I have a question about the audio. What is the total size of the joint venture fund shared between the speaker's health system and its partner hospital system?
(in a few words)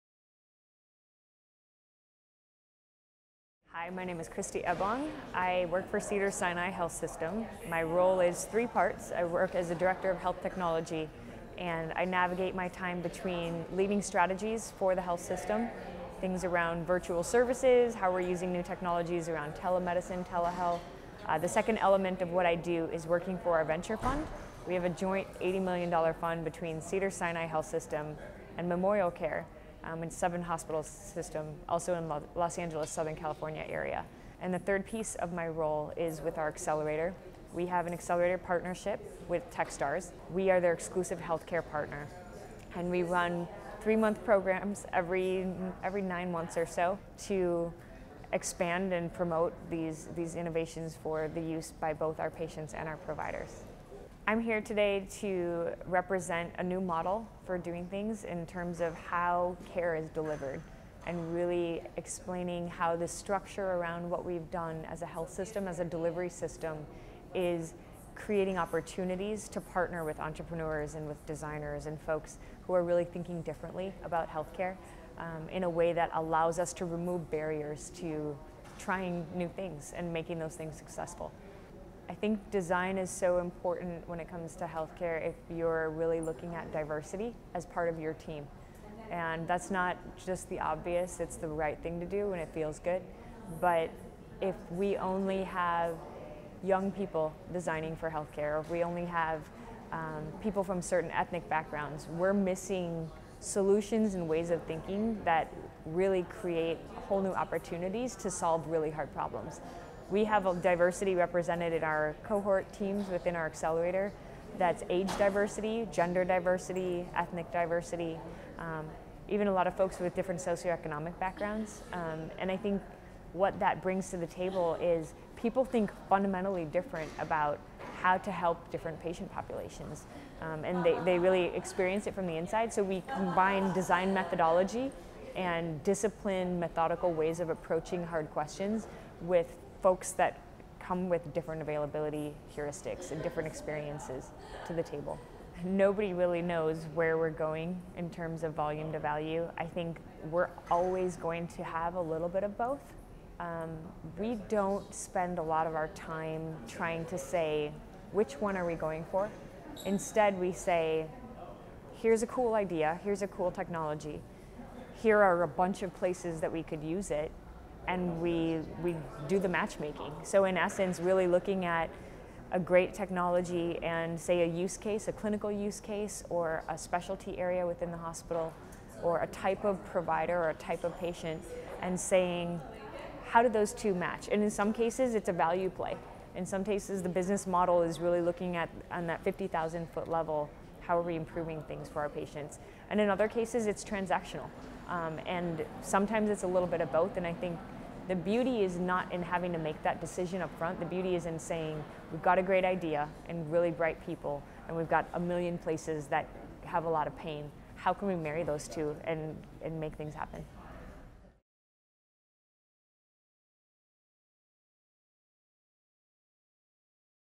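$80 million.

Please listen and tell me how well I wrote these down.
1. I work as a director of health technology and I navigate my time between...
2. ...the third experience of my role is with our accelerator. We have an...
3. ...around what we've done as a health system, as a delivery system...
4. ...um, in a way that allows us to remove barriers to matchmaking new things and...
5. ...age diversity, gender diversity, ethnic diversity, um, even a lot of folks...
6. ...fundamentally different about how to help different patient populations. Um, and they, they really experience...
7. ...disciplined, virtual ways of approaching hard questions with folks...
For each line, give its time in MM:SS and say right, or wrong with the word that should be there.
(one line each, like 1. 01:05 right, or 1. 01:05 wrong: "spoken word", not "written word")
1. 00:09 right
2. 00:34 wrong: "piece", not "experience"
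3. 01:03 right
4. 01:15 wrong: "trying", not "matchmaking"
5. 01:54 right
6. 02:06 right
7. 02:15 wrong: "methodical", not "virtual".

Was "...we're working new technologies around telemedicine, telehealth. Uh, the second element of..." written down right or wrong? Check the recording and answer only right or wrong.
wrong.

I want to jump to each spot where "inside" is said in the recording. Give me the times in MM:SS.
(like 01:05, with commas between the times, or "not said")
02:12.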